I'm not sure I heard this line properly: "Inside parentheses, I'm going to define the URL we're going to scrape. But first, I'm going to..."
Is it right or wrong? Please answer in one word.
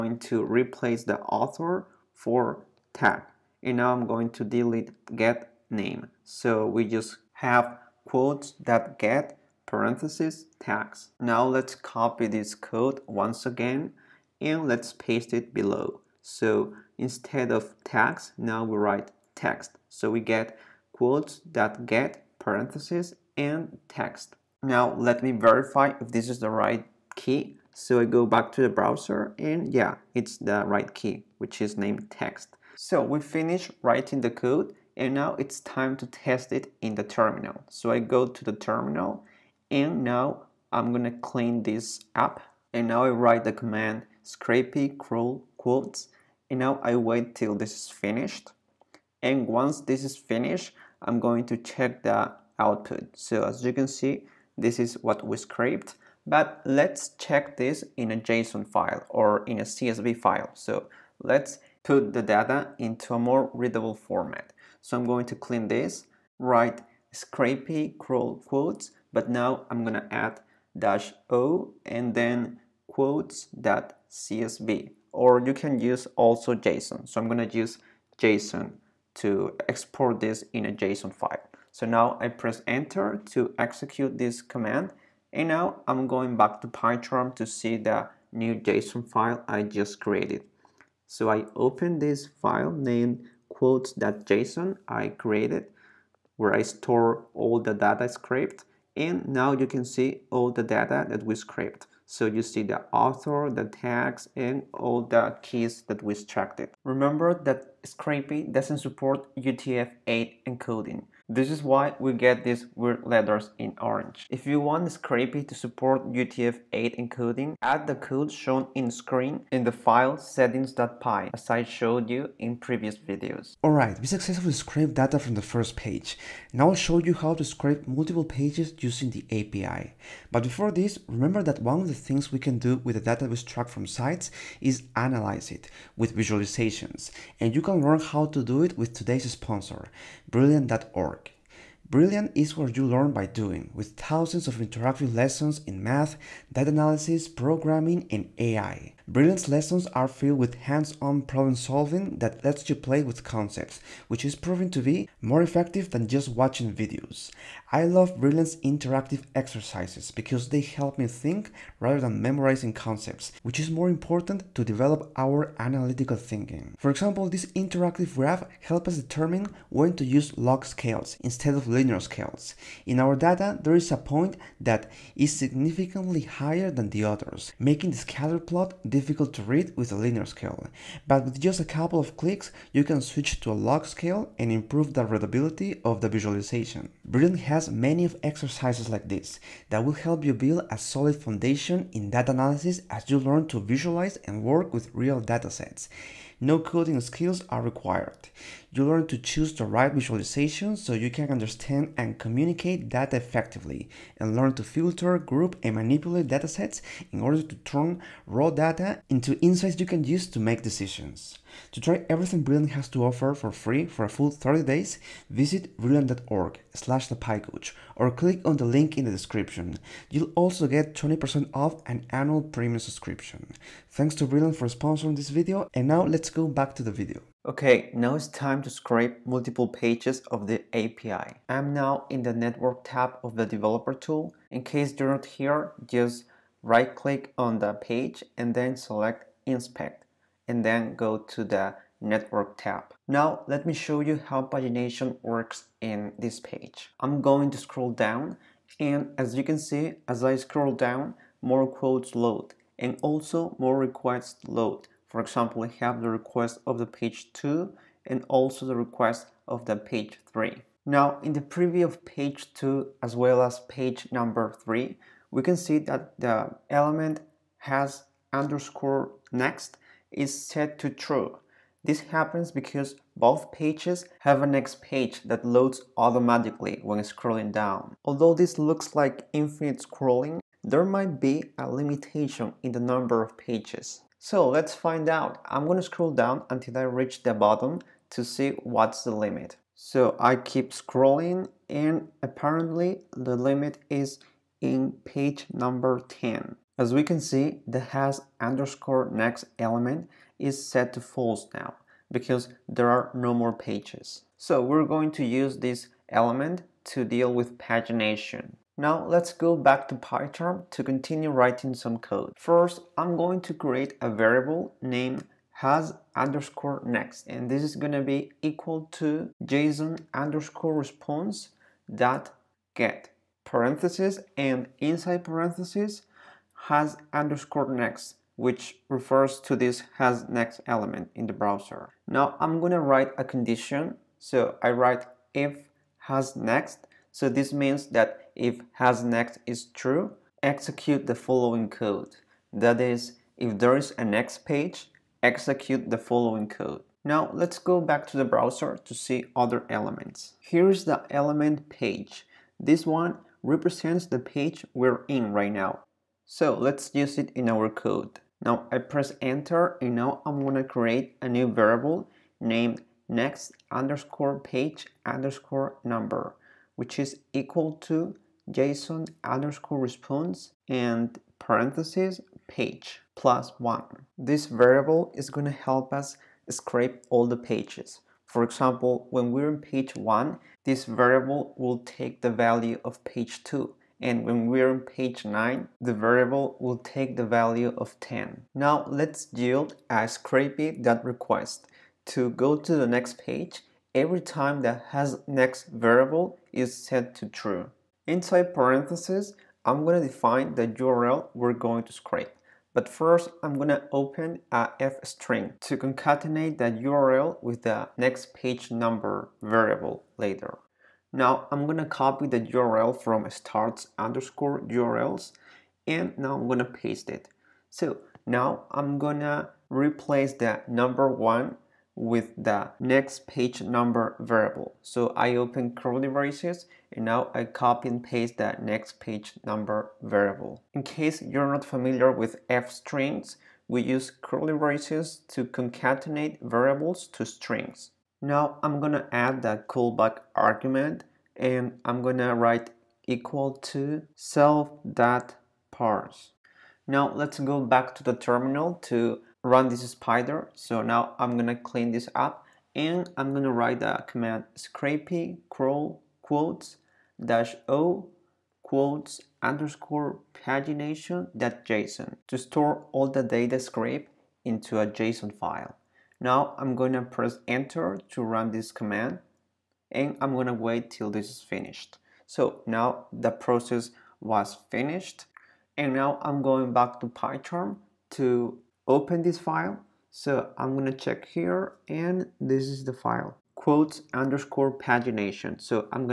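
right.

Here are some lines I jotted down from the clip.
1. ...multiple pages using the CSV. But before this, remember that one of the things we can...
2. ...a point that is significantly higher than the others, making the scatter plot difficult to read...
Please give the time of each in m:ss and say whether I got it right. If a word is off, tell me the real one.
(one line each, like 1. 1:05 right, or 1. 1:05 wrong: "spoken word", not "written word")
1. 2:07 wrong: "API", not "CSV"
2. 2:53 right.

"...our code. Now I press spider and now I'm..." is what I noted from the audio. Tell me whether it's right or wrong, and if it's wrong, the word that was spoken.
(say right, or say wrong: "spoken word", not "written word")
wrong: "enter", not "spider".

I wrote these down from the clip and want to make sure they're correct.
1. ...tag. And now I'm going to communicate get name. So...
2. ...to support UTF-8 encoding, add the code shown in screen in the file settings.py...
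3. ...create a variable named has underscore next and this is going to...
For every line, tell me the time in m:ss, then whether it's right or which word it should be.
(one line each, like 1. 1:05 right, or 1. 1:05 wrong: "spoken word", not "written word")
1. 0:02 wrong: "delete", not "communicate"
2. 1:55 right
3. 5:13 right.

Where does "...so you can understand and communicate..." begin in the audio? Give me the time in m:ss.
3:20.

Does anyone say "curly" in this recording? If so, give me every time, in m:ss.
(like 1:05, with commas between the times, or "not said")
7:05, 7:14.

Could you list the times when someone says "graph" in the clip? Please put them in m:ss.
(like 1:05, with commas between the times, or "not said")
2:48.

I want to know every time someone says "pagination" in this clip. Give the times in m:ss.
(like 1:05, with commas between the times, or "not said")
4:04, 5:07, 7:40, 8:04.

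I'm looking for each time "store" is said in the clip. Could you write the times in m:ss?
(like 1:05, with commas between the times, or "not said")
1:36, 7:42.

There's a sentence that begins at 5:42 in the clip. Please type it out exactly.
That is, if there is a next page, execute the following code.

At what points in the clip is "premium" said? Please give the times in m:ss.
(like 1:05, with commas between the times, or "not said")
3:42.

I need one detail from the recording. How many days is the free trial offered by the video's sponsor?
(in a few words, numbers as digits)
30.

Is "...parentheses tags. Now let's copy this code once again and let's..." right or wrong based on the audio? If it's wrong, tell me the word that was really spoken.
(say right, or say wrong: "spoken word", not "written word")
right.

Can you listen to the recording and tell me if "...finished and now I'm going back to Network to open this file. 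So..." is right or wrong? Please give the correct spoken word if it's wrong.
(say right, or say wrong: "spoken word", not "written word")
wrong: "PyCharm", not "Network".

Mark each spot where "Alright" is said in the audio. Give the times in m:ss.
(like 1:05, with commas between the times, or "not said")
2:03.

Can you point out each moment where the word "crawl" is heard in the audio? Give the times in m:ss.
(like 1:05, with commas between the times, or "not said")
0:44, 1:07, 7:35.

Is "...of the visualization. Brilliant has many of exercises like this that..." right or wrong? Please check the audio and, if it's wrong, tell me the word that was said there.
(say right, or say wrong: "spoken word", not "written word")
right.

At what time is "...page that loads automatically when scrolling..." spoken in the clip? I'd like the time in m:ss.
4:34.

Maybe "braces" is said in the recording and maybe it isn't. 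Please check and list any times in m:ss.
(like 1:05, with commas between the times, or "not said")
7:06, 7:14.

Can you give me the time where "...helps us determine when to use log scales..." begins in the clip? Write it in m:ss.
2:48.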